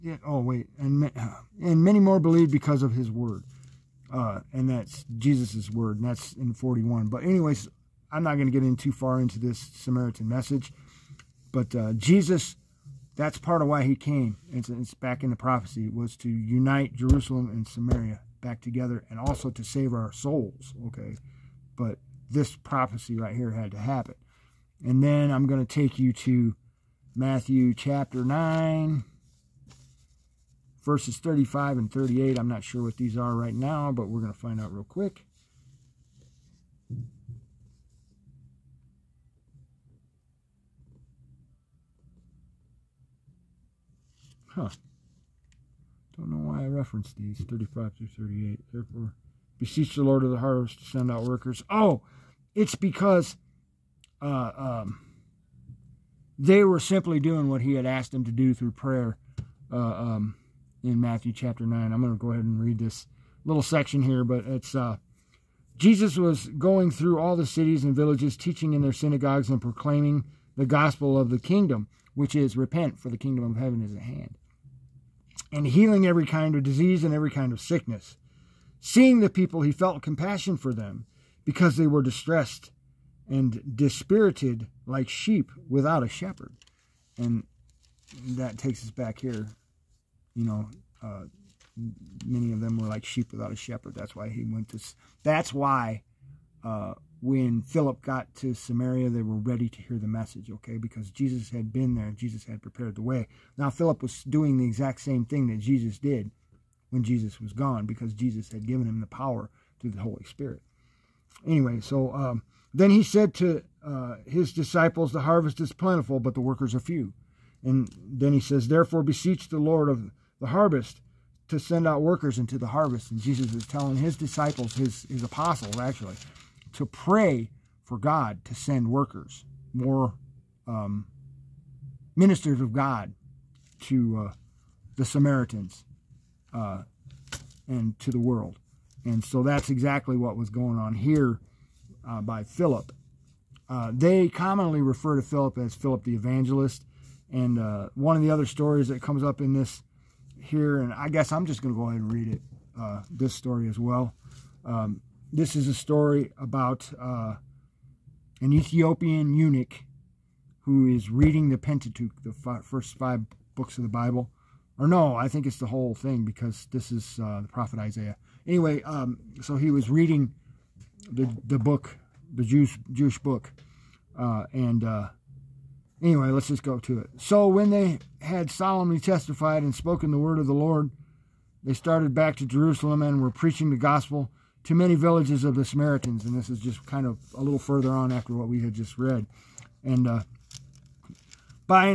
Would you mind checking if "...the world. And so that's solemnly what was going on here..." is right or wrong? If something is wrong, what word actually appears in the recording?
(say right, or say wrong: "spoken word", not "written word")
wrong: "exactly", not "solemnly".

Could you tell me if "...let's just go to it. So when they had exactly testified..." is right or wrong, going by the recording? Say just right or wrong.
wrong.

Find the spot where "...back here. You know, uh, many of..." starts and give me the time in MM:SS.
01:28.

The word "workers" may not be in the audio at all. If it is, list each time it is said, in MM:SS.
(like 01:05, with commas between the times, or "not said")
00:51, 01:56, 02:02, 02:08.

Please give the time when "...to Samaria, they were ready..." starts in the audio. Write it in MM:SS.
01:38.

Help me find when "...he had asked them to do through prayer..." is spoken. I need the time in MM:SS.
00:57.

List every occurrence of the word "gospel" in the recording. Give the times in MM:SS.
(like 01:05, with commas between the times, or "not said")
01:10, 03:03.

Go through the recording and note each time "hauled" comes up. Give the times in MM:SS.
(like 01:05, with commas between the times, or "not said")
not said.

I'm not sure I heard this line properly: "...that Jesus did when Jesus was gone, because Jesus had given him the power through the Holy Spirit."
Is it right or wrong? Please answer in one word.
right.